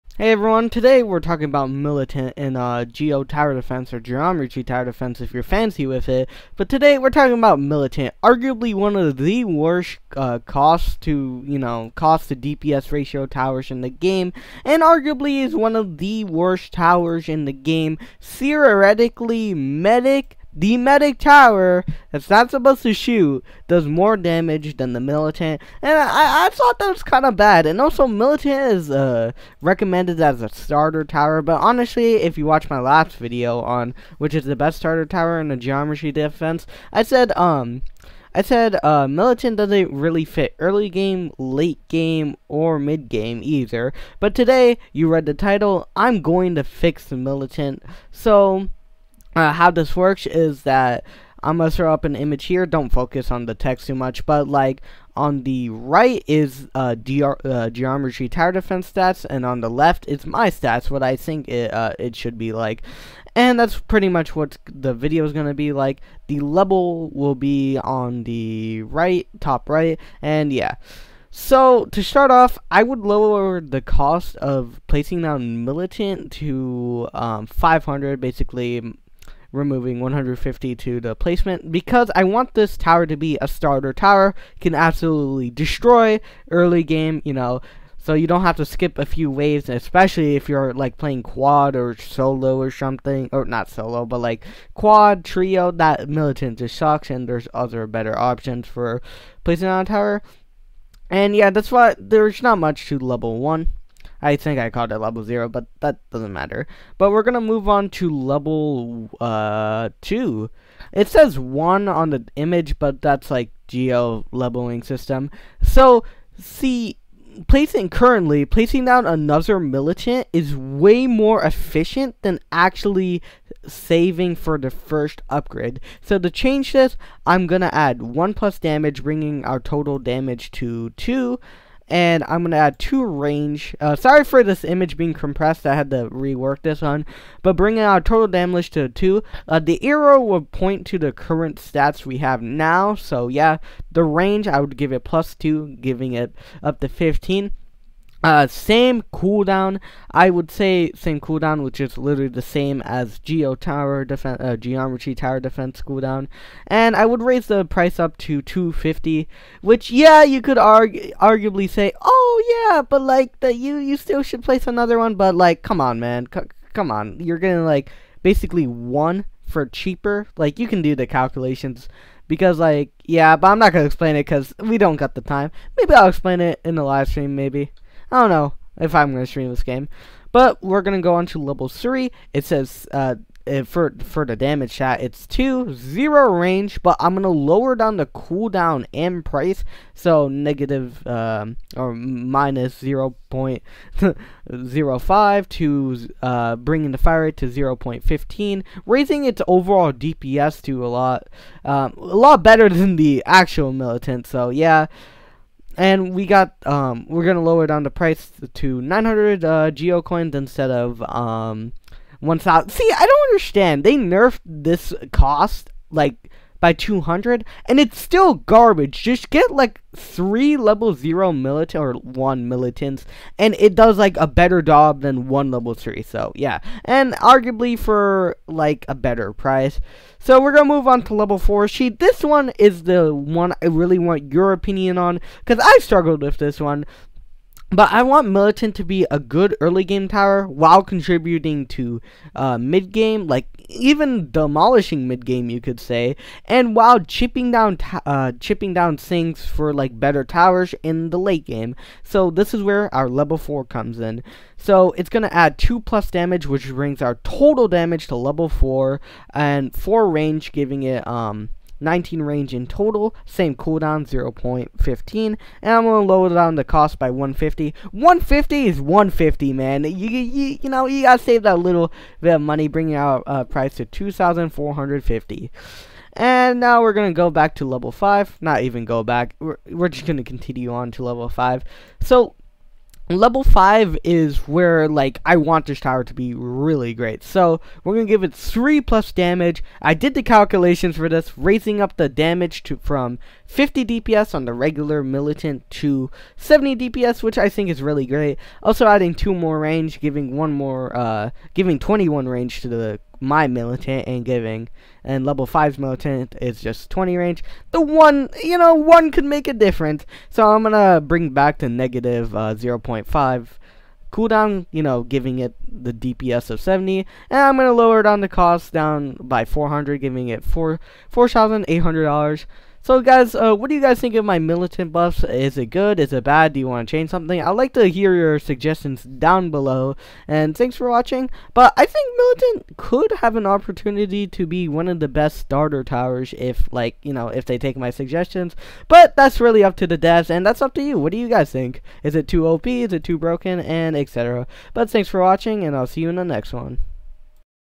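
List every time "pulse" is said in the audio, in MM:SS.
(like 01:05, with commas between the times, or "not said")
not said.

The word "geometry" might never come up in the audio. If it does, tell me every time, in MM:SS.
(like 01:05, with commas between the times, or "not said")
00:03, 00:35, 00:57, 02:34.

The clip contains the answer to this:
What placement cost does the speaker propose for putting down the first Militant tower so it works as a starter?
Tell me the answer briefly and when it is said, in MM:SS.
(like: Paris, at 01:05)
500, at 01:17.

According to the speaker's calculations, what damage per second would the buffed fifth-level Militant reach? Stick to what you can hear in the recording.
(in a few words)
70 DPS.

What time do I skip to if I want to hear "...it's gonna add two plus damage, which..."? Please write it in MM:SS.
04:14.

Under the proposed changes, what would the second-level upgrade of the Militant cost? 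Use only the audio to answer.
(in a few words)
250.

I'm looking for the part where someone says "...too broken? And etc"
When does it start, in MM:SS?
05:43.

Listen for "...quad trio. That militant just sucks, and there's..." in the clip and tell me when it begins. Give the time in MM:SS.
01:34.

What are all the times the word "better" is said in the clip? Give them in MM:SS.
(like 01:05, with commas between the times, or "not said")
01:37, 03:22, 03:44, 03:48, 04:10.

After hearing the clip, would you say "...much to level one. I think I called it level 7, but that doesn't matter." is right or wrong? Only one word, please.
wrong.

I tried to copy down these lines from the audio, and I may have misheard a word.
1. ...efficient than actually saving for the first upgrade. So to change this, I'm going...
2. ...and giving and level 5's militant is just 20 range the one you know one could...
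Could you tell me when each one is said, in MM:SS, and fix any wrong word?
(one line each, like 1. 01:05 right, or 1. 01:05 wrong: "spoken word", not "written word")
1. 02:01 right
2. 05:04 right.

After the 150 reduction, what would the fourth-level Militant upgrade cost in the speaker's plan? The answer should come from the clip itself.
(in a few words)
2,450.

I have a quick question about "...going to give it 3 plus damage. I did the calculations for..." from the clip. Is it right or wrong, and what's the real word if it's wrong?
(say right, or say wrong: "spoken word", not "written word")
right.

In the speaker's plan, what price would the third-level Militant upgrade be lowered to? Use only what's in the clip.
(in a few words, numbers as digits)
900.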